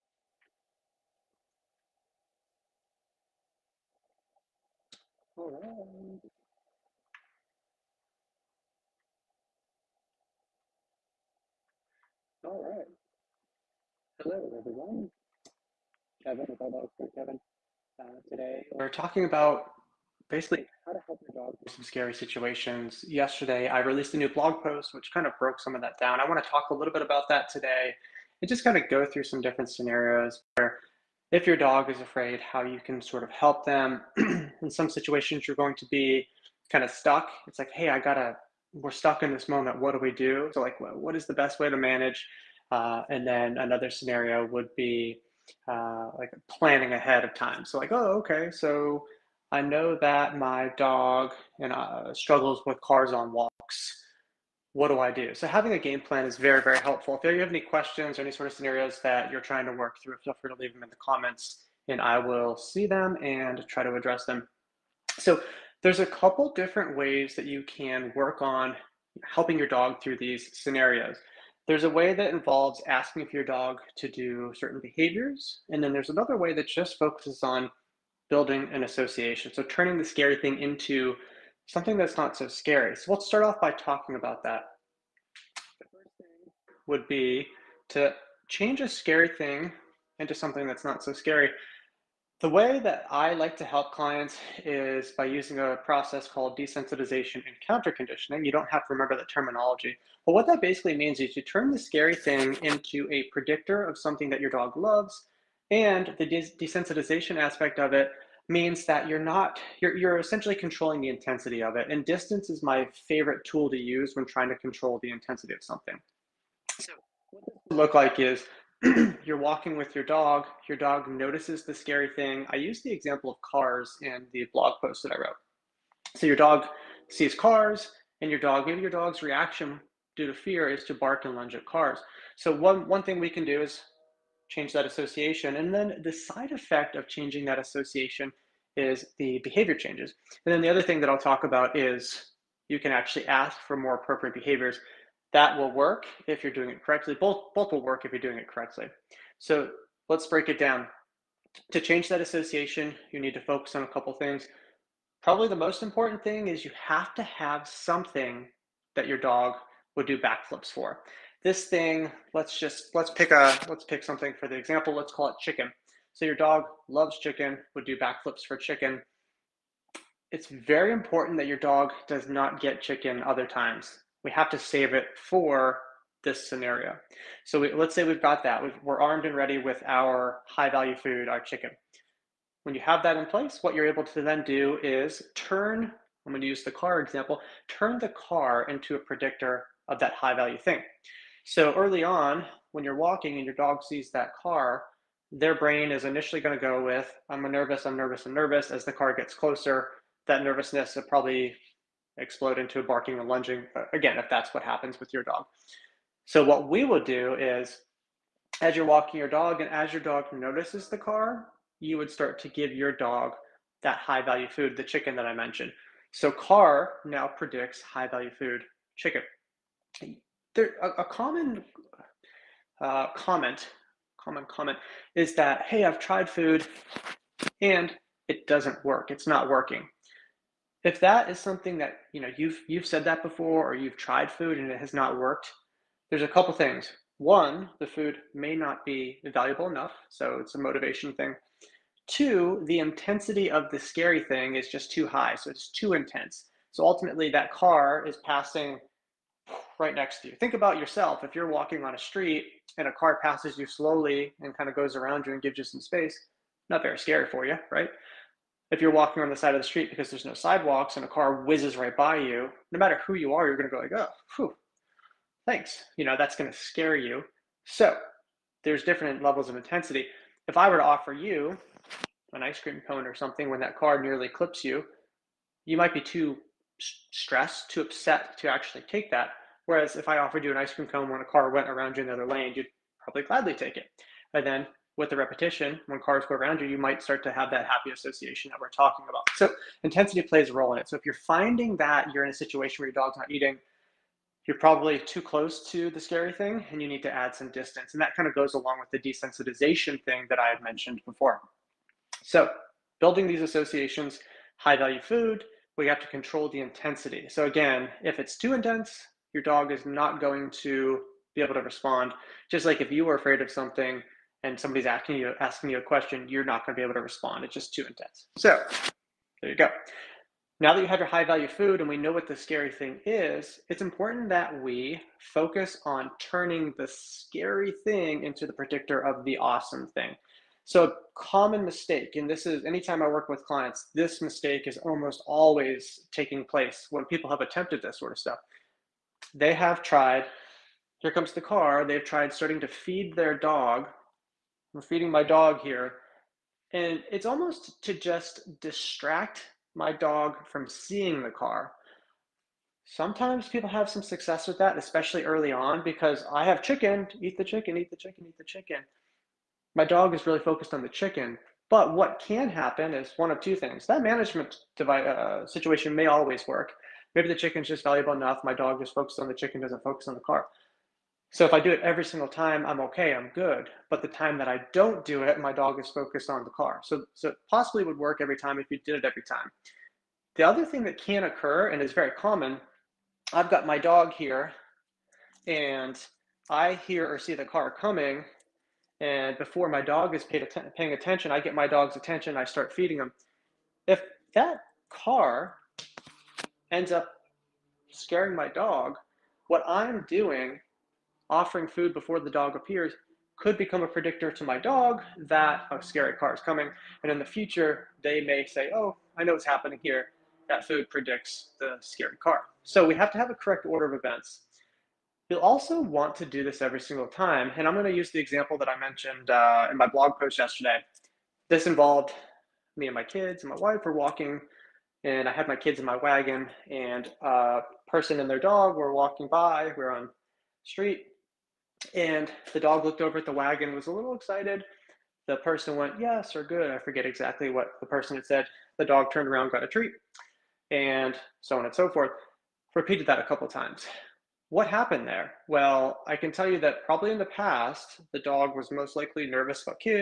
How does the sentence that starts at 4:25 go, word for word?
You know, that's going to scare you.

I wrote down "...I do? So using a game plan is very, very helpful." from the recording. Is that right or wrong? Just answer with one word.
wrong.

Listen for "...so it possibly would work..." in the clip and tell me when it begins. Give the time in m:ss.
6:17.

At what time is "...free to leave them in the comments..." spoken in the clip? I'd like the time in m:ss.
1:00.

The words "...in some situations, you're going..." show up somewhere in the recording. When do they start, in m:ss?
0:34.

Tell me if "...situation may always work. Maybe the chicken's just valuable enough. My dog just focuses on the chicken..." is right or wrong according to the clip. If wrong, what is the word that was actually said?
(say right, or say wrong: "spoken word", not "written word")
right.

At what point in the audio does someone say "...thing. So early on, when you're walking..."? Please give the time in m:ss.
3:10.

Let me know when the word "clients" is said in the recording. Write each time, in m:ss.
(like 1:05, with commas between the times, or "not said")
1:33, 5:33.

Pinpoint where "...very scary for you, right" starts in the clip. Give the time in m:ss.
4:16.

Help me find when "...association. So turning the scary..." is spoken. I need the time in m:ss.
1:18.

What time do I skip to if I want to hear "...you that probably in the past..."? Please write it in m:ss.
7:26.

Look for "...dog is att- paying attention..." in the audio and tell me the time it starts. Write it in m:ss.
6:29.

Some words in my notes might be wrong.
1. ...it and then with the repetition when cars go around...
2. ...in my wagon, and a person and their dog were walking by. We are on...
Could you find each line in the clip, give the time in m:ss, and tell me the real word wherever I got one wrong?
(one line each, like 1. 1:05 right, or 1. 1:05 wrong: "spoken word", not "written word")
1. 4:43 right
2. 7:05 right.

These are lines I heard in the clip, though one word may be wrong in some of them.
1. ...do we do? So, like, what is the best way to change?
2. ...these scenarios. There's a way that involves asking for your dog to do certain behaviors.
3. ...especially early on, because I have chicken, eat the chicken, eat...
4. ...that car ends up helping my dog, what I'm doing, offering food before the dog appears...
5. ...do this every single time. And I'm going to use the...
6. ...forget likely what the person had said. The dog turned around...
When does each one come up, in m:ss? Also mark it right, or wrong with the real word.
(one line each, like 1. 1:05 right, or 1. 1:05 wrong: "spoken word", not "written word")
1. 0:39 wrong: "manage", not "change"
2. 1:10 right
3. 5:54 right
4. 6:34 wrong: "scaring", not "helping"
5. 6:56 right
6. 7:16 wrong: "exactly", not "likely".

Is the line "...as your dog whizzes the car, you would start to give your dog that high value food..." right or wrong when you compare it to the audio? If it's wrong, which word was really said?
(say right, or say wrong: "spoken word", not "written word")
wrong: "notices", not "whizzes".